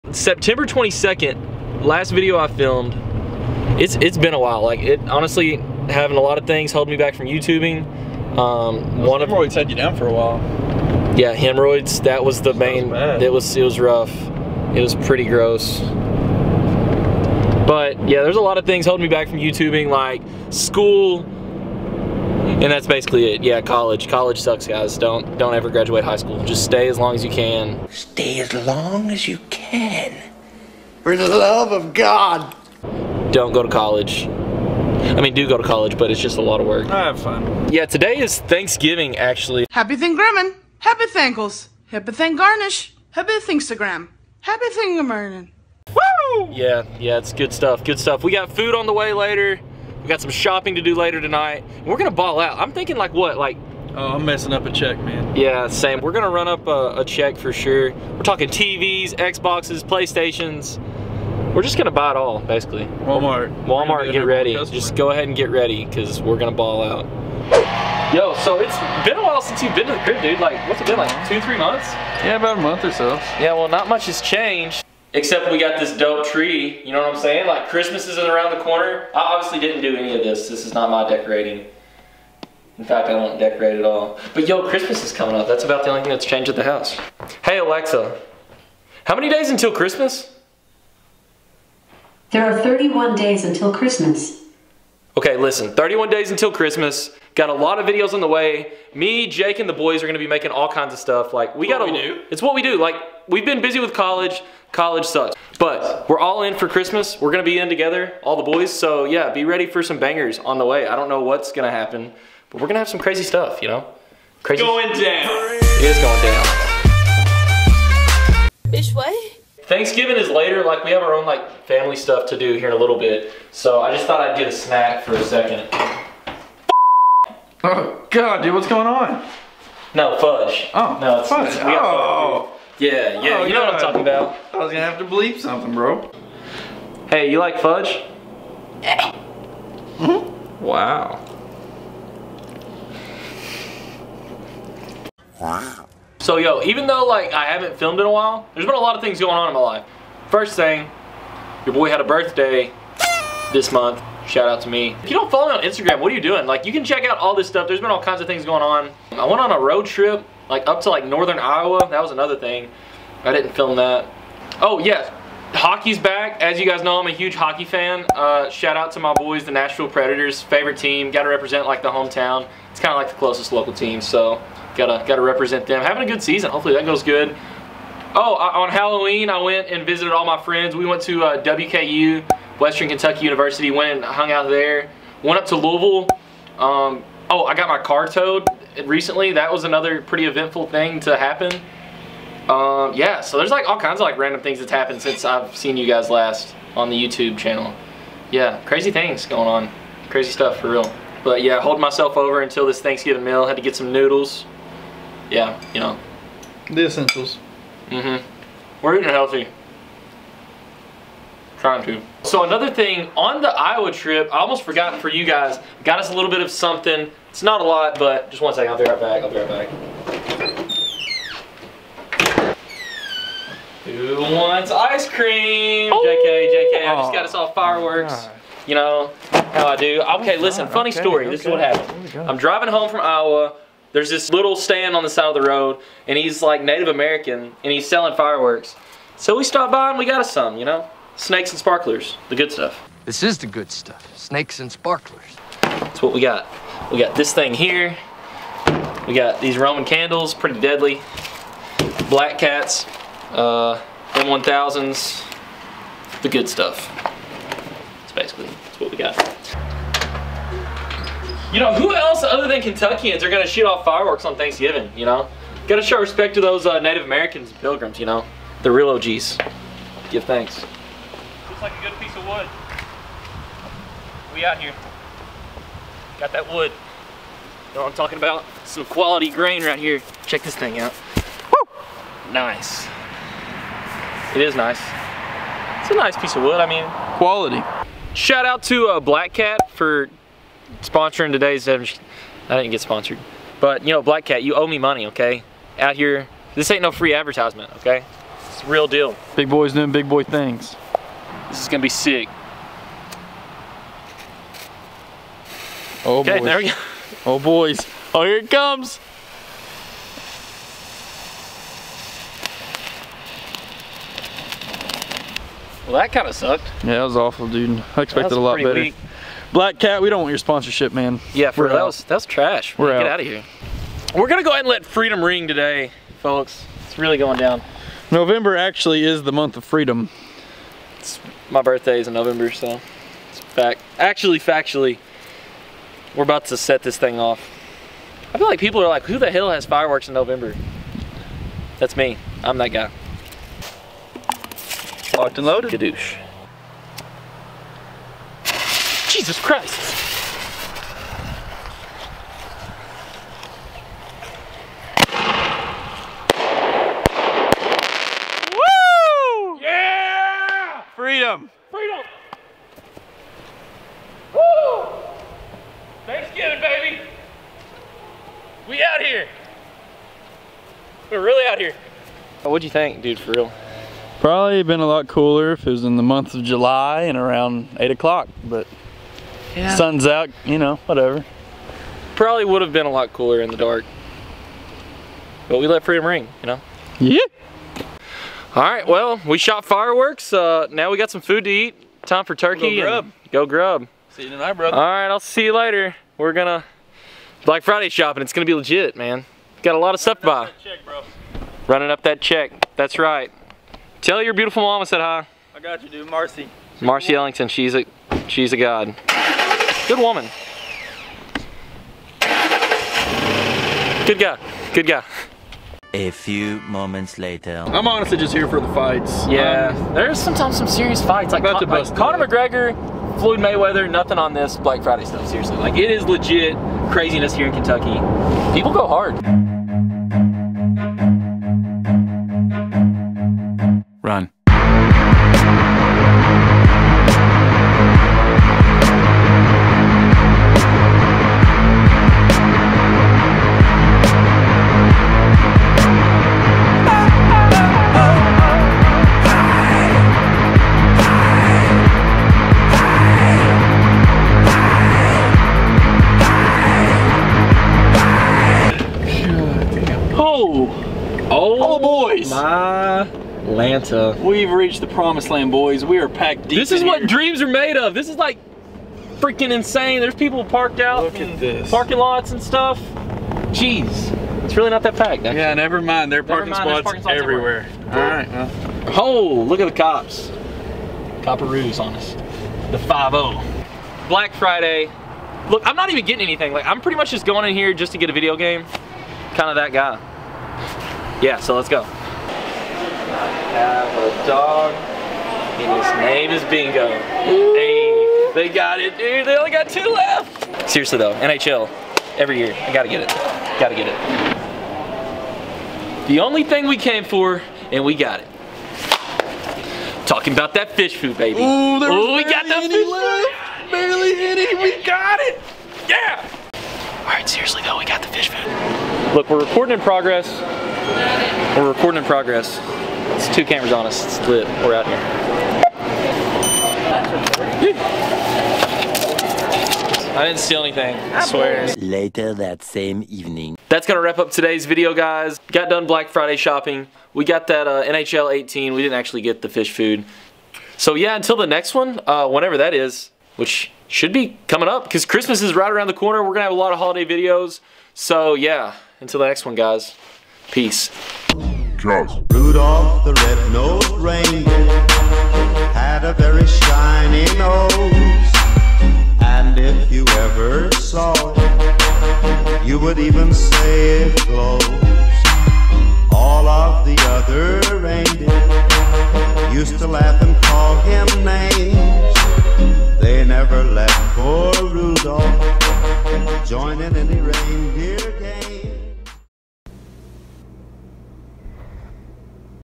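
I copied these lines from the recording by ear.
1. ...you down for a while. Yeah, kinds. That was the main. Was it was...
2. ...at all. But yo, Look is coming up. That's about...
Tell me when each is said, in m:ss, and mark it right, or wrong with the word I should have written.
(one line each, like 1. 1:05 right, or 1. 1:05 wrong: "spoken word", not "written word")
1. 0:09 wrong: "hemorrhoids", not "kinds"
2. 1:23 wrong: "Christmas", not "Look".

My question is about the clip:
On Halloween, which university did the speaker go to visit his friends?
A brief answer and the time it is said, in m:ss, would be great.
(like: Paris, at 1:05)
Western Kentucky University, at 3:02.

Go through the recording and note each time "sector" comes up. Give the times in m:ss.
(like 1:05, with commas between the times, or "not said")
not said.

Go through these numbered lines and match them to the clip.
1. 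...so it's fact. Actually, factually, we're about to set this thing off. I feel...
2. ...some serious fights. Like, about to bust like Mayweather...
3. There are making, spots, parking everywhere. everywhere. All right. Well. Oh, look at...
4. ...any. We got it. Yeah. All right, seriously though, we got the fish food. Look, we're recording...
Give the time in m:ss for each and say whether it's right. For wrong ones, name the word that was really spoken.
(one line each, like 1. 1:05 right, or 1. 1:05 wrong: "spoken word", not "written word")
1. 5:32 right
2. 7:00 wrong: "Conor", not "Mayweather"
3. 7:56 wrong: "parking", not "making"
4. 8:34 right.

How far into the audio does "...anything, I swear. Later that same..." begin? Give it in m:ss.
8:50.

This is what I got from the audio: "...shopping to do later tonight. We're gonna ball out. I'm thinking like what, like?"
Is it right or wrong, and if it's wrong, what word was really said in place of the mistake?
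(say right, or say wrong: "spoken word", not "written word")
right.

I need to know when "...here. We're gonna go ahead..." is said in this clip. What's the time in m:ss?
5:23.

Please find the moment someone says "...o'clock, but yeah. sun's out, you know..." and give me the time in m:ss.
6:17.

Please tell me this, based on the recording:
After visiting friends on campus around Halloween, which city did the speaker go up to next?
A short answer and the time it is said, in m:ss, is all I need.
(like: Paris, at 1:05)
Louisville, at 3:05.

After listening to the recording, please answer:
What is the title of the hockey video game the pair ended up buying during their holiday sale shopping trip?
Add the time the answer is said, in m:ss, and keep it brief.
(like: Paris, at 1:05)
NHL 18, at 8:57.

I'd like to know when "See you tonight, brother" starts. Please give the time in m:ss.
6:34.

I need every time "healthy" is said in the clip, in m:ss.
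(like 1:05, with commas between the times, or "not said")
3:29.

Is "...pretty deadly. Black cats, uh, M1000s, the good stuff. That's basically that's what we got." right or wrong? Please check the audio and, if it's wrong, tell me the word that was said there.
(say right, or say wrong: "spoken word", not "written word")
right.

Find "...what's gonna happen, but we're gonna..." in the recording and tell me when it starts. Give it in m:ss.
1:51.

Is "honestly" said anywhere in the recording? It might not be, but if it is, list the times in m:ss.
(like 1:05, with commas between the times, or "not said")
0:05, 6:57.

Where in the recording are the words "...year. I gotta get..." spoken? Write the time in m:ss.
8:22.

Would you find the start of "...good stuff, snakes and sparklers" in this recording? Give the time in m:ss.
4:03.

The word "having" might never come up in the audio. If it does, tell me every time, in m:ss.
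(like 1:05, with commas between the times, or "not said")
0:05, 2:55.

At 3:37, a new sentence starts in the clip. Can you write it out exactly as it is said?
It's not a lot, but just one second, I'll be right back, I'll be right back.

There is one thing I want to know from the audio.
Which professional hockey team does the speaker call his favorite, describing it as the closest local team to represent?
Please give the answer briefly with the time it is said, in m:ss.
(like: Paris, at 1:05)
Nashville Predators, at 2:49.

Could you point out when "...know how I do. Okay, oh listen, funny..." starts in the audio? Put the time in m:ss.
3:48.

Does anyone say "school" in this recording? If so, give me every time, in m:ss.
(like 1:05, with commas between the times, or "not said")
0:20, 0:26.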